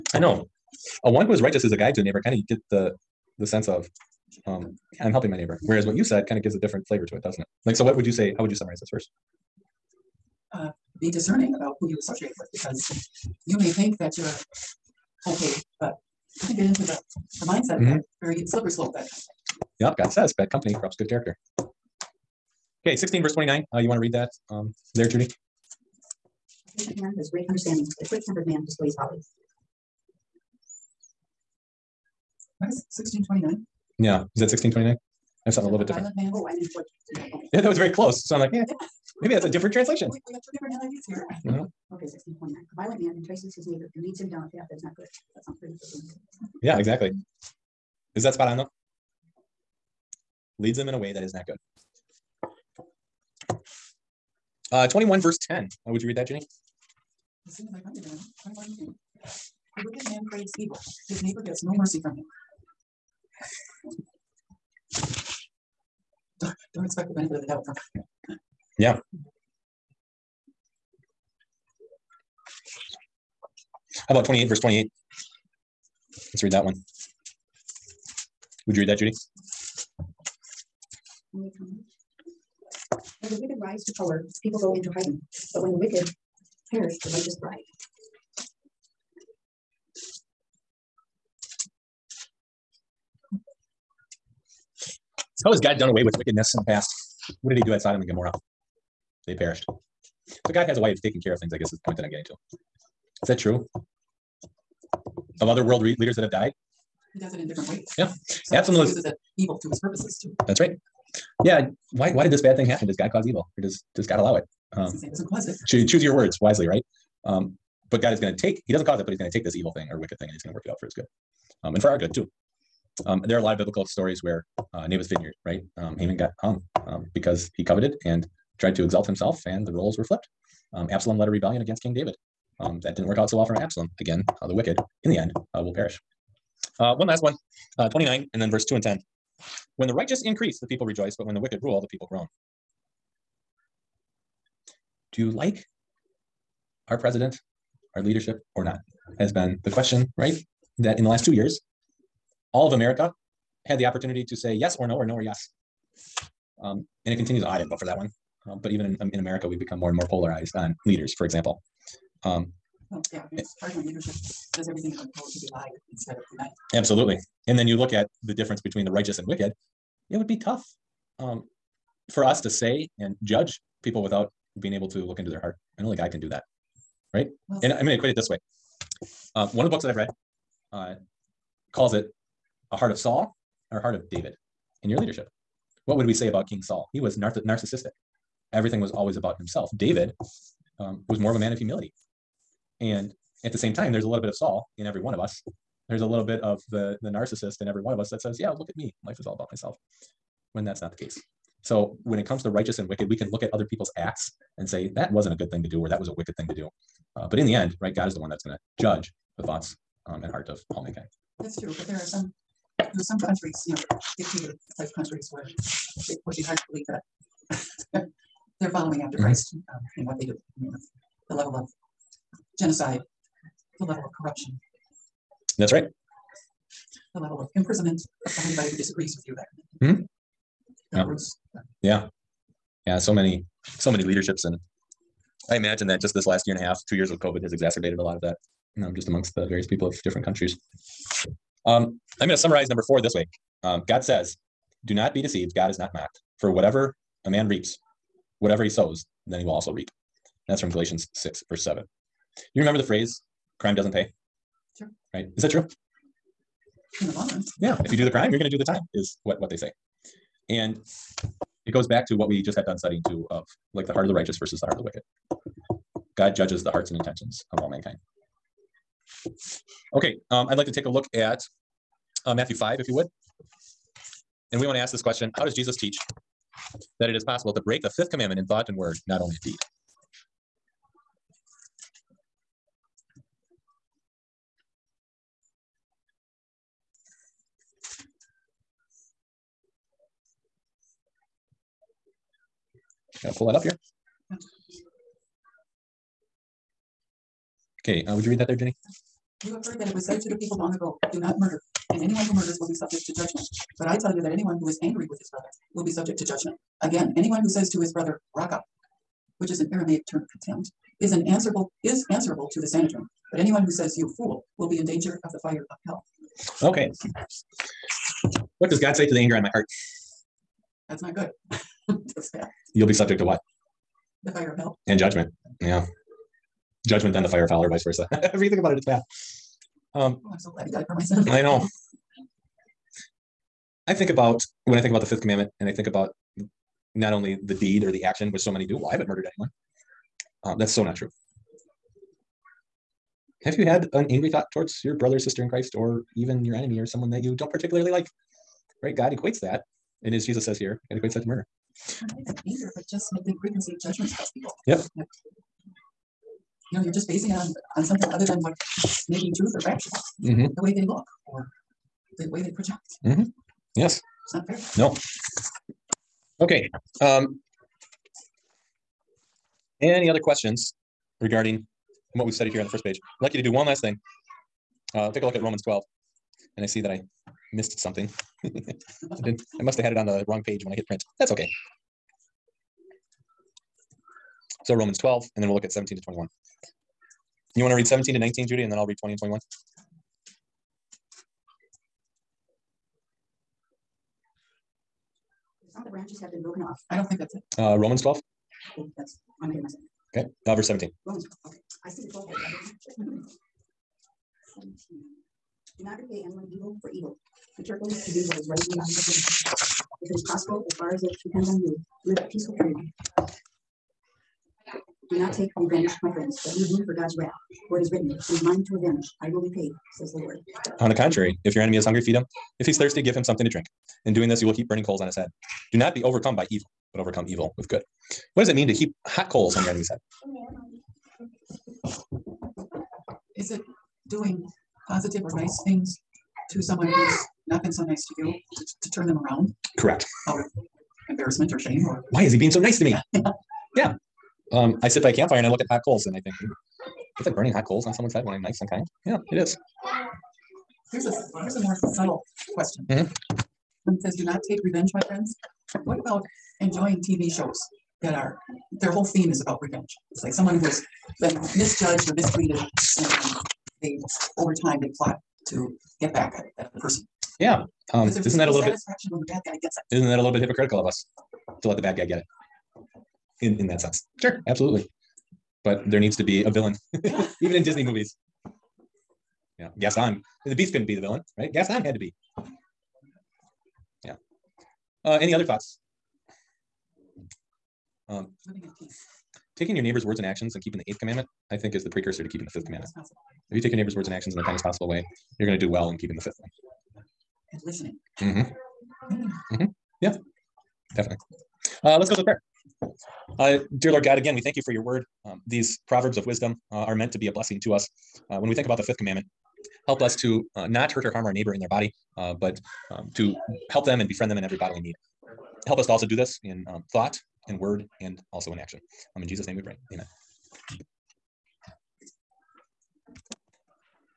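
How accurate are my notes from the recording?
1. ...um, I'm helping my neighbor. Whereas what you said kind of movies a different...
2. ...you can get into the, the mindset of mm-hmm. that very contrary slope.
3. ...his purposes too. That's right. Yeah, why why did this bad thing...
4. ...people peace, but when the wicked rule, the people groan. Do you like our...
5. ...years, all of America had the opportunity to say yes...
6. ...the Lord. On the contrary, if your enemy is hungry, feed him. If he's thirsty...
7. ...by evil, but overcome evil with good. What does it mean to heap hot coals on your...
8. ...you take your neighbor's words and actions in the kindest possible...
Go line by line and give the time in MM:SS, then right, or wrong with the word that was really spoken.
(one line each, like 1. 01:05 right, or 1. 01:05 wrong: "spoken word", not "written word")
1. 00:04 wrong: "gives", not "movies"
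2. 00:16 wrong: "slippery", not "contrary"
3. 01:49 right
4. 02:20 wrong: "rejoice", not "peace"
5. 02:31 right
6. 07:00 right
7. 07:06 right
8. 08:13 right.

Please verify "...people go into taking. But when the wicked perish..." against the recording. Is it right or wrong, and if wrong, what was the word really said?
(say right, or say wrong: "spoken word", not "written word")
wrong: "hiding", not "taking".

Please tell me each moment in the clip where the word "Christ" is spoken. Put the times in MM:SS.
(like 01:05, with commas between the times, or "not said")
03:39, 05:45.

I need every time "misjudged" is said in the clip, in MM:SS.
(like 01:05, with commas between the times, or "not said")
07:41.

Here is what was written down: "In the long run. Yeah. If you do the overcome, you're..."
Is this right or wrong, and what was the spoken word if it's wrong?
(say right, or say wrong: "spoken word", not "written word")
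wrong: "crime", not "overcome".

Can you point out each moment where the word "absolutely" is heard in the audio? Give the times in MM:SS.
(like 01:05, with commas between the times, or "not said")
01:48, 02:46, 07:54.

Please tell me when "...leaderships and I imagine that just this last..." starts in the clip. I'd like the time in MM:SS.
03:54.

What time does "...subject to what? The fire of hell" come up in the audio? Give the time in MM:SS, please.
05:22.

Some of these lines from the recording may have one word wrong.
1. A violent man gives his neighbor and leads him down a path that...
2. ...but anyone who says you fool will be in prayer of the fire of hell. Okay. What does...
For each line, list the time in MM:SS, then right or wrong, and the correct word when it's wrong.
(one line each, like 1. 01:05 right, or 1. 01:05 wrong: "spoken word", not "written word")
1. 00:42 wrong: "entices", not "gives"
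2. 05:13 wrong: "danger", not "prayer".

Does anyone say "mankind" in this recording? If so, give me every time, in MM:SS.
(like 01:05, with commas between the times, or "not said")
03:30, 04:27.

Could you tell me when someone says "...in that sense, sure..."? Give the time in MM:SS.
07:53.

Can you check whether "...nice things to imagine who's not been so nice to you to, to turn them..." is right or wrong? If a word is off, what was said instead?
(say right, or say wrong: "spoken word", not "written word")
wrong: "someone", not "imagine".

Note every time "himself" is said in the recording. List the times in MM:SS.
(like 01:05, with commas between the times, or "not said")
02:09, 03:09.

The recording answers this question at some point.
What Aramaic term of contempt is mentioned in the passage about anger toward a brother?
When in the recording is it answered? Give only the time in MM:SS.
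05:08.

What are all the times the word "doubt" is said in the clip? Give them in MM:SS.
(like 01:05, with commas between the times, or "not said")
01:07.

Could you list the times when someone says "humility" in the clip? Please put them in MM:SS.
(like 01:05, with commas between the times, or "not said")
03:11.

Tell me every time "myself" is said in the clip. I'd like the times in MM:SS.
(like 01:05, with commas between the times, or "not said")
03:19, 06:39.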